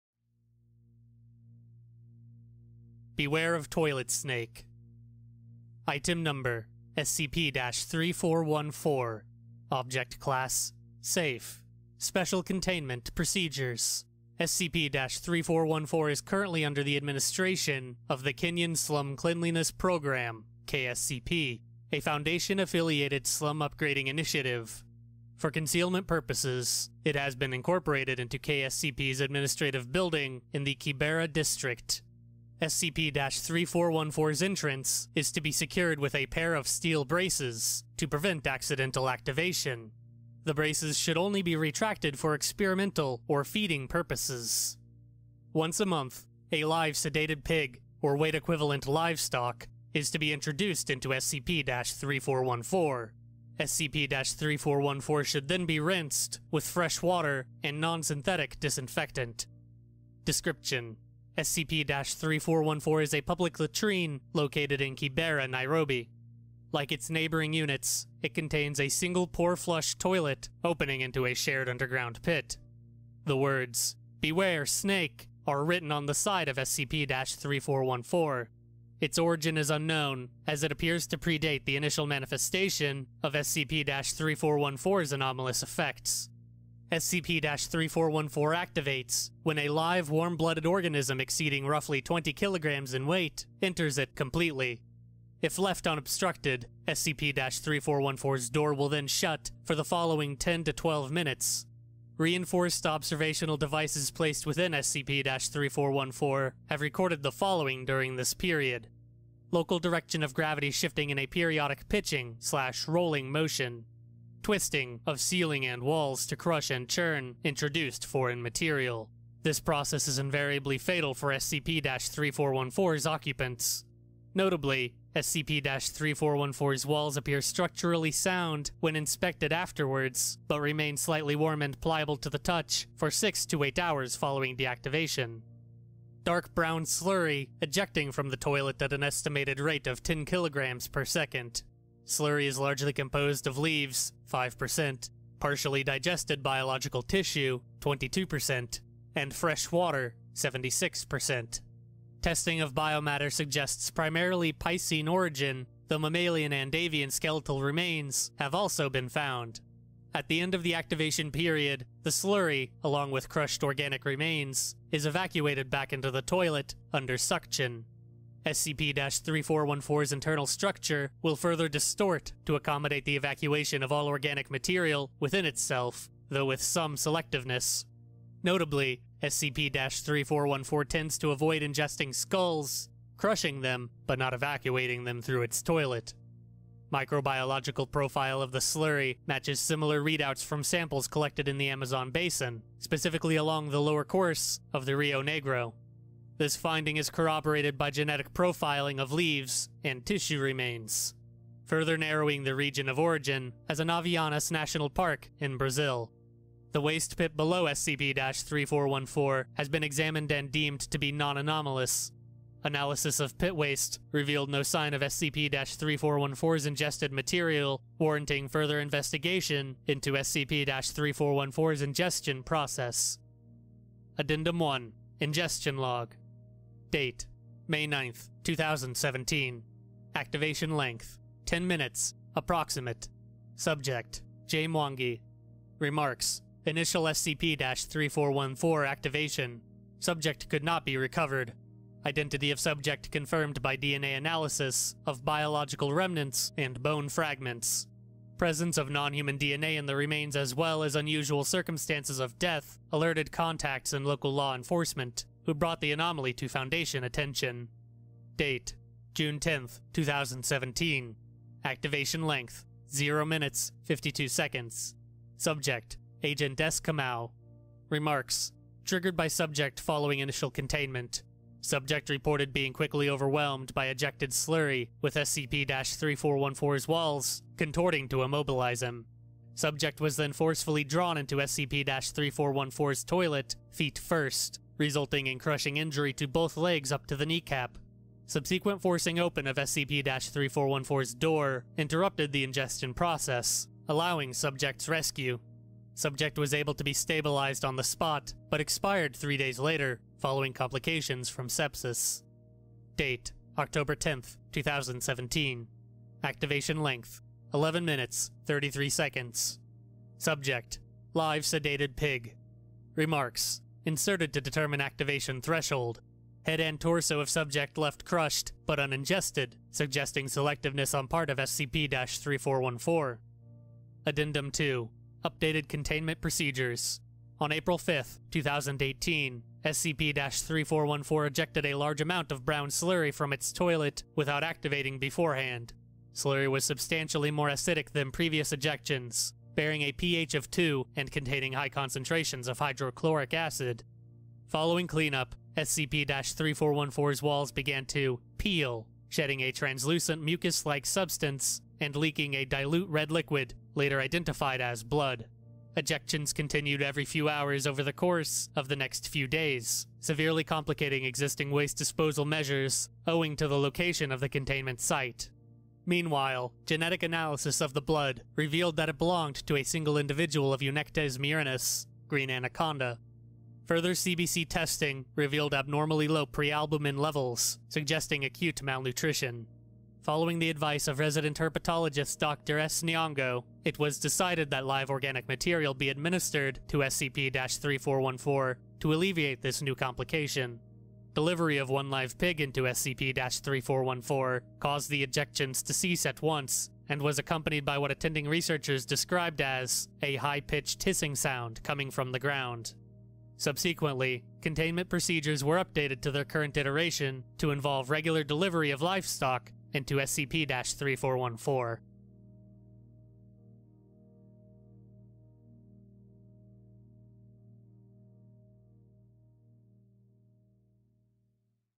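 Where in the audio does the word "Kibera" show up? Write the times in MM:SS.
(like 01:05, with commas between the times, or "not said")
00:30, 01:04.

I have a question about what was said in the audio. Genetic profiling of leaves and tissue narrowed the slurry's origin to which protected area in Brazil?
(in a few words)
Anavilhanas National Park.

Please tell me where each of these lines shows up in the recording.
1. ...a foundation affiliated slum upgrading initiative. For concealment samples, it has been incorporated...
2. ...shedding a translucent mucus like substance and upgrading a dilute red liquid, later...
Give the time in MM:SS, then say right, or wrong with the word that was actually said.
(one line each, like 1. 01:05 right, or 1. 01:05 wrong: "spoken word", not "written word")
1. 00:21 wrong: "purposes", not "samples"
2. 05:49 wrong: "leaking", not "upgrading".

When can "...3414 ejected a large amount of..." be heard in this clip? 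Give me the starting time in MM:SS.
05:30.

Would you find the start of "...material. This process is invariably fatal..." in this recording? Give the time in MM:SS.
01:58.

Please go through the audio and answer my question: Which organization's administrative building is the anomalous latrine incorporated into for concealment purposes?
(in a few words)
Kenyan Slum Cleanliness Program.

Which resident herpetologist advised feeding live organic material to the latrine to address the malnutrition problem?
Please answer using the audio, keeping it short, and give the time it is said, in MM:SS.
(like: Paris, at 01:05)
Dr. S. Nyongo, at 06:22.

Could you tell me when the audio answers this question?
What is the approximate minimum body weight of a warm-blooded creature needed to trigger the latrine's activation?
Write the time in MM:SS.
01:32.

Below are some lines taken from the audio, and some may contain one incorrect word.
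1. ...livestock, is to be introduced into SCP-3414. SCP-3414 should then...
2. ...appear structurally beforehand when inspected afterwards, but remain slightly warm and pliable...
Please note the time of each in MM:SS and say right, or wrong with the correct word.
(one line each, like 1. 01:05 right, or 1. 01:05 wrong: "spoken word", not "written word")
1. 00:48 right
2. 02:07 wrong: "sound", not "beforehand".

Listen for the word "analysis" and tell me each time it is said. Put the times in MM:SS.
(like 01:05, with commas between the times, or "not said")
03:32, 04:04, 06:07.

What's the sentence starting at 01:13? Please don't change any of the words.
The words, Beware Snake, are written on the side of SCP-3414.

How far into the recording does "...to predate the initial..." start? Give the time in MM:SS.
01:21.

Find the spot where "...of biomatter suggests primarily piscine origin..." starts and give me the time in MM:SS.
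02:32.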